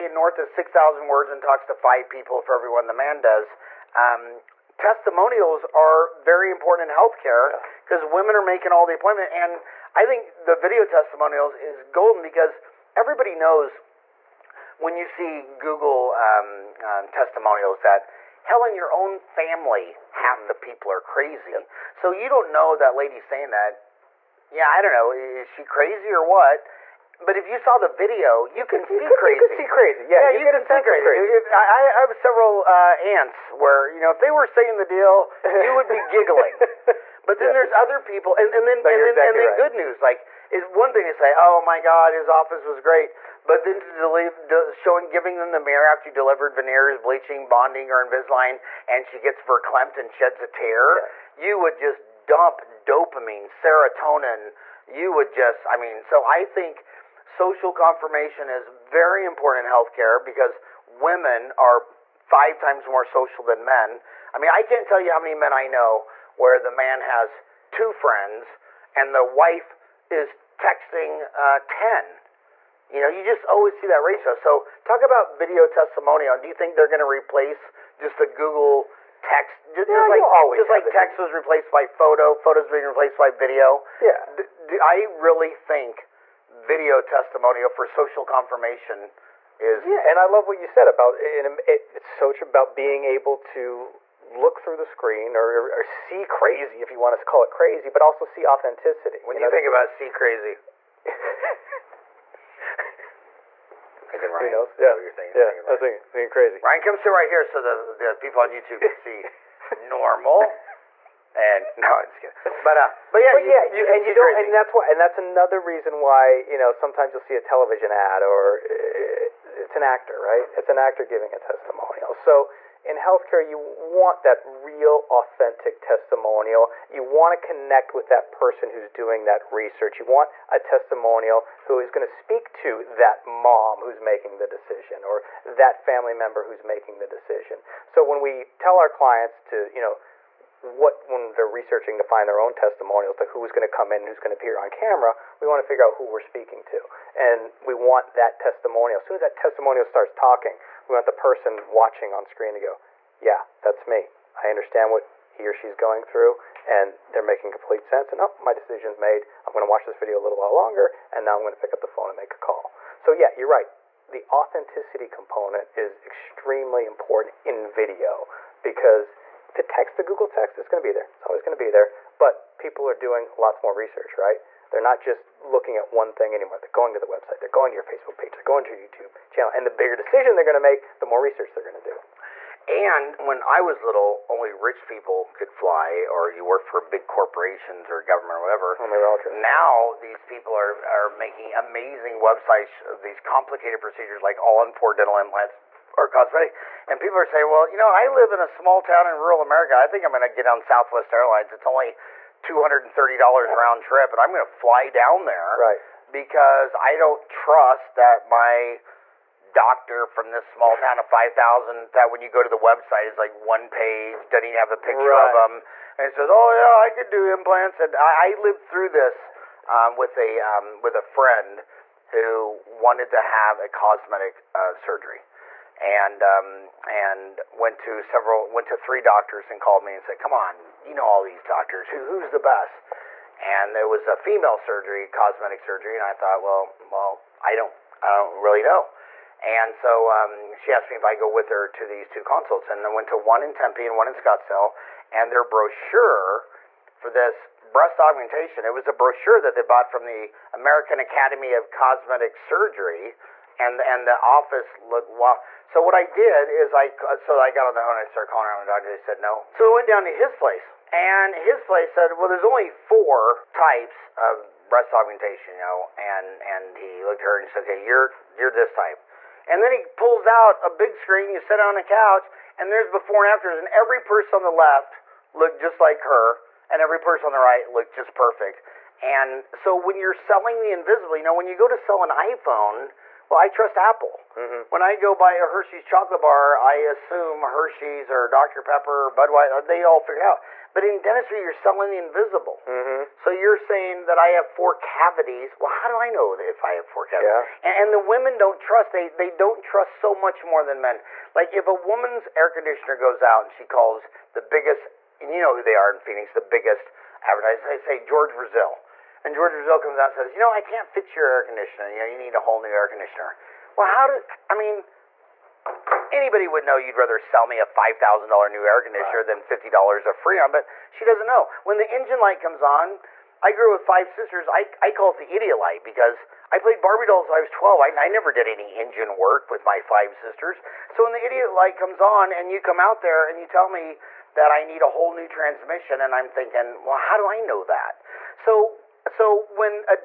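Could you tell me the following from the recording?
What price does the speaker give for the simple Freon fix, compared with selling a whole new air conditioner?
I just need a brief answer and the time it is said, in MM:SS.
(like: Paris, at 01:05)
$50, at 05:19.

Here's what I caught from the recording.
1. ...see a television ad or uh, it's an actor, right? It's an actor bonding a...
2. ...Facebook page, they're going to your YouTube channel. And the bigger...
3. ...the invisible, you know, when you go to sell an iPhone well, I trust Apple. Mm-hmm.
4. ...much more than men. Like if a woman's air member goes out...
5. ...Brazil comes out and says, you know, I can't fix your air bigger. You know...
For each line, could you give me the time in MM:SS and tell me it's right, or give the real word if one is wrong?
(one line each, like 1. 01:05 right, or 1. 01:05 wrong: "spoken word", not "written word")
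1. 01:57 wrong: "giving", not "bonding"
2. 02:57 right
3. 04:40 right
4. 05:00 wrong: "conditioner", not "member"
5. 05:09 wrong: "conditioner", not "bigger".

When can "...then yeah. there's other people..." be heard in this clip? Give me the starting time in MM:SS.
00:37.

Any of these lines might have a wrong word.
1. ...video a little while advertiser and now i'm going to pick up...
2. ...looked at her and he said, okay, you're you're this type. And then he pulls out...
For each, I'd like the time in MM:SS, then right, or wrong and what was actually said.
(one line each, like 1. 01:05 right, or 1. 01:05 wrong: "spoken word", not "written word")
1. 02:39 wrong: "longer", not "advertiser"
2. 04:27 right.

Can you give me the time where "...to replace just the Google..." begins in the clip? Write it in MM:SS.
01:16.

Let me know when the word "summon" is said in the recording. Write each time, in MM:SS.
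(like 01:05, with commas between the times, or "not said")
not said.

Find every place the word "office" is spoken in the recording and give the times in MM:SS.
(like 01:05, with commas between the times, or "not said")
00:42, 04:14.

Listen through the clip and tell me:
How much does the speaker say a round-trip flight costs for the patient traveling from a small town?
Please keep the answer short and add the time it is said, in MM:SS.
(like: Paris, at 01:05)
$230, at 03:22.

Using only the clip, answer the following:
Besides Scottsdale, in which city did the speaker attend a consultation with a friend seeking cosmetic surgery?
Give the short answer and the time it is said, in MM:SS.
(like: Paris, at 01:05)
Tempe, at 04:03.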